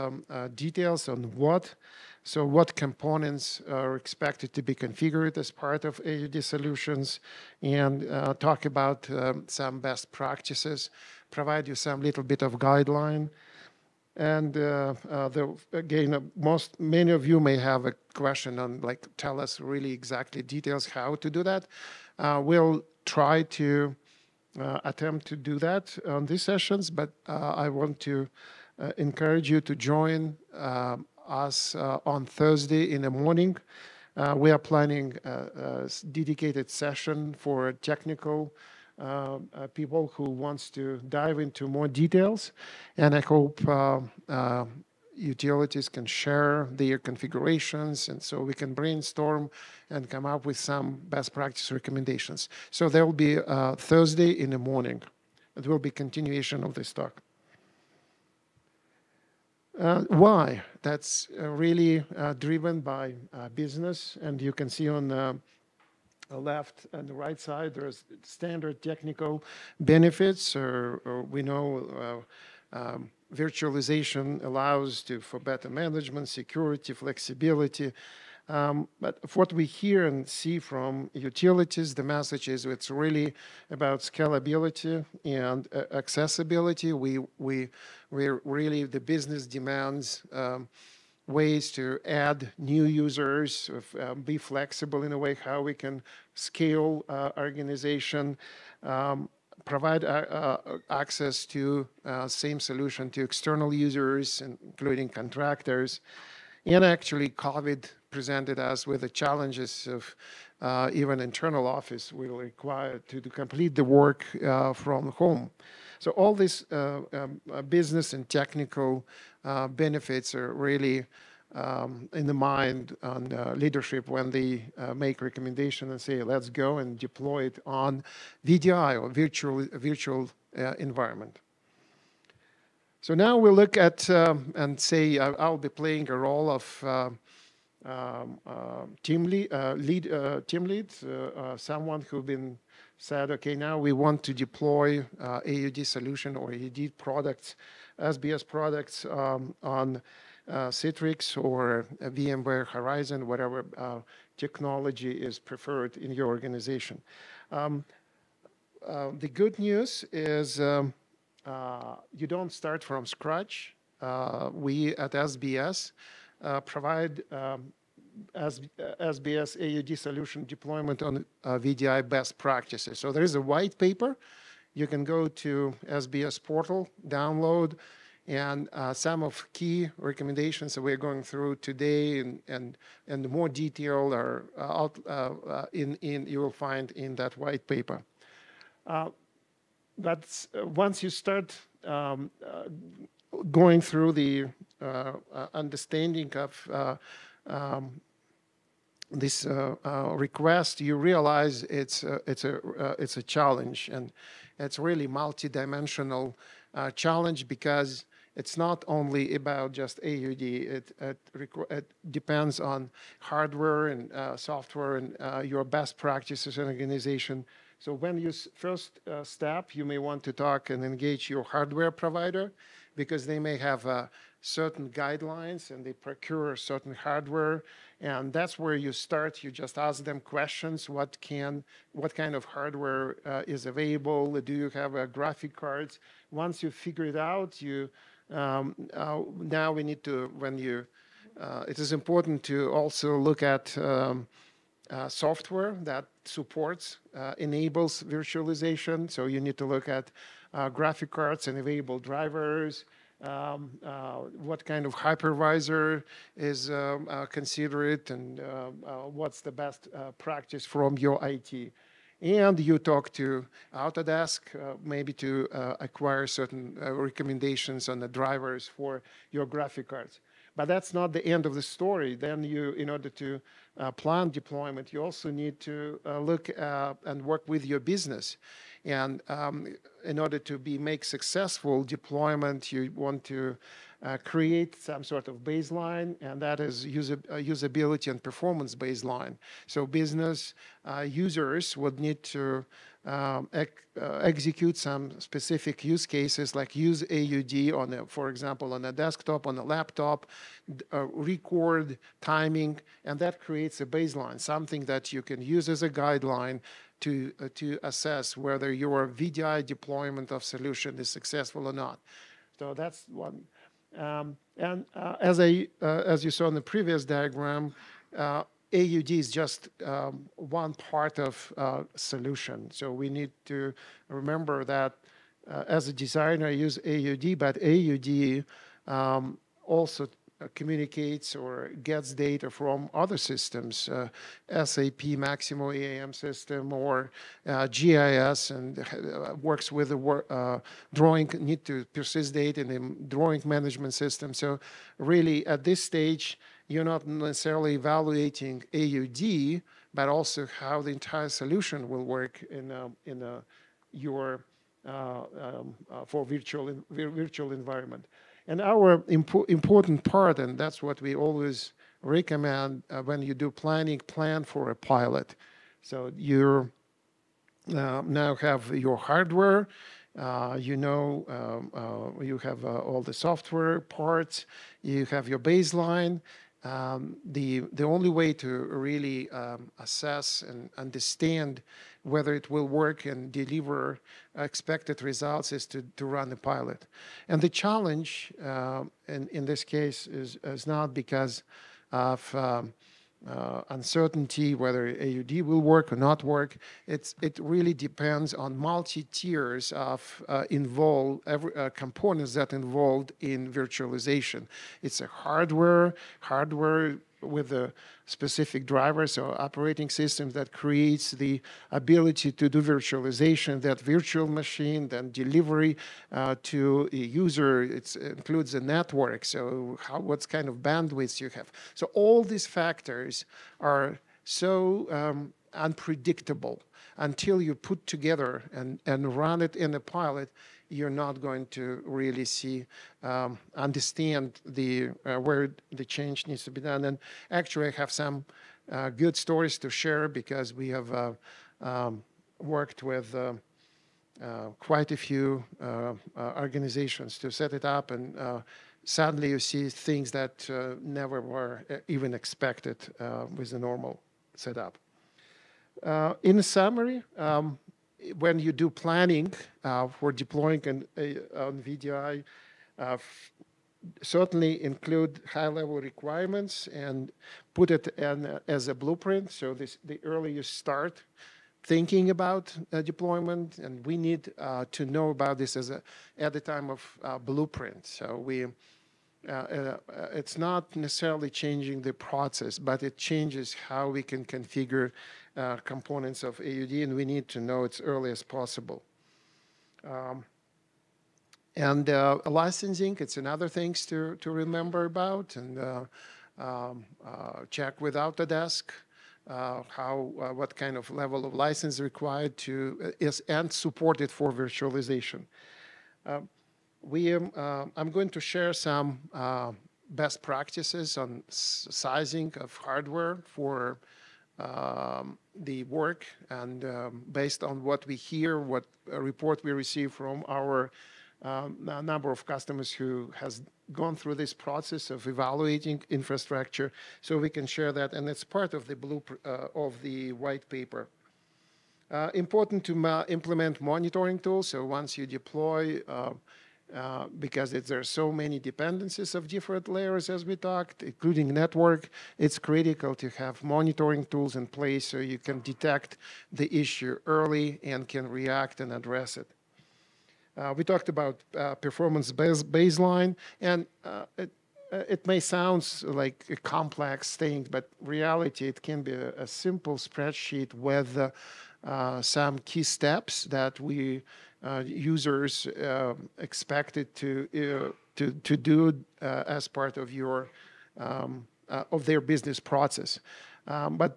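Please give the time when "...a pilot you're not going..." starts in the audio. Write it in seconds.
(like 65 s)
429 s.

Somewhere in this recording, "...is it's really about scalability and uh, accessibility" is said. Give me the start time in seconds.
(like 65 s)
82 s.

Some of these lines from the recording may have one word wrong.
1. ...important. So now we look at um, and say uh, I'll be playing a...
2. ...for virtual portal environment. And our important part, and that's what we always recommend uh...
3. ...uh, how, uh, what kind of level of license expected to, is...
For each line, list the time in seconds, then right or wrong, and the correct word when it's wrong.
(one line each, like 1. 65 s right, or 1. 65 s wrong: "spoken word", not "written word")
1. 130 s wrong: "environment", not "important"
2. 356 s wrong: "virtual", not "portal"
3. 499 s wrong: "required", not "expected".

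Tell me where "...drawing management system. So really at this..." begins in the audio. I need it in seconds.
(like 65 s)
343 s.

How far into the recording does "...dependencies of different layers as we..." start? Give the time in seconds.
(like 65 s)
538 s.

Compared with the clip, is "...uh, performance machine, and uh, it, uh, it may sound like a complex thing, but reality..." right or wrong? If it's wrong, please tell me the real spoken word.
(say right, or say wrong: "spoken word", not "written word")
wrong: "baseline", not "machine".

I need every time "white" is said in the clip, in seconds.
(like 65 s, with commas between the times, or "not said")
173 s, 187 s, 530 s.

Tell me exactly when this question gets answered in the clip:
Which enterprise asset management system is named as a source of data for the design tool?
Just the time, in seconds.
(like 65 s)
334 s.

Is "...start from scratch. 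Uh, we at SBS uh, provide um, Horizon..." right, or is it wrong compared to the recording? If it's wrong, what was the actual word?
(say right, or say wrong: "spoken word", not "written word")
wrong: "SBS", not "Horizon".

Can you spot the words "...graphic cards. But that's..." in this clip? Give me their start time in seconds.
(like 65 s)
269 s.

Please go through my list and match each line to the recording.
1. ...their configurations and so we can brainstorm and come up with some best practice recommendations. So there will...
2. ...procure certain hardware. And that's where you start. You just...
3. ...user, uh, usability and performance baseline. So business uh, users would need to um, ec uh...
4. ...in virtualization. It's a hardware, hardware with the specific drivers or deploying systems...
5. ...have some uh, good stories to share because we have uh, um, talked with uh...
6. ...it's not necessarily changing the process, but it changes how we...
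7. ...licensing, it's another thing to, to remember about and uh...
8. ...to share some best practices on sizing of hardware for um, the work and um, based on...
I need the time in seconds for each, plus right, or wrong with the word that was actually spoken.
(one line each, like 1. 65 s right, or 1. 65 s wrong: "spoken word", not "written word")
1. 46 s right
2. 225 s right
3. 286 s right
4. 403 s wrong: "operating", not "deploying"
5. 437 s wrong: "worked", not "talked"
6. 479 s right
7. 492 s right
8. 508 s right.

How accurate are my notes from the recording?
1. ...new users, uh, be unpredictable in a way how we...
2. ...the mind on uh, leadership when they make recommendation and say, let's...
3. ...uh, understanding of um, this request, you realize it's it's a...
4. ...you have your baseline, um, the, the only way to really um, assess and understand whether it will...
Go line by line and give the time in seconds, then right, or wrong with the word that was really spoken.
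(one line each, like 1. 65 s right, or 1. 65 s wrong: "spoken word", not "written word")
1. 92 s wrong: "flexible", not "unpredictable"
2. 122 s right
3. 194 s right
4. 374 s right.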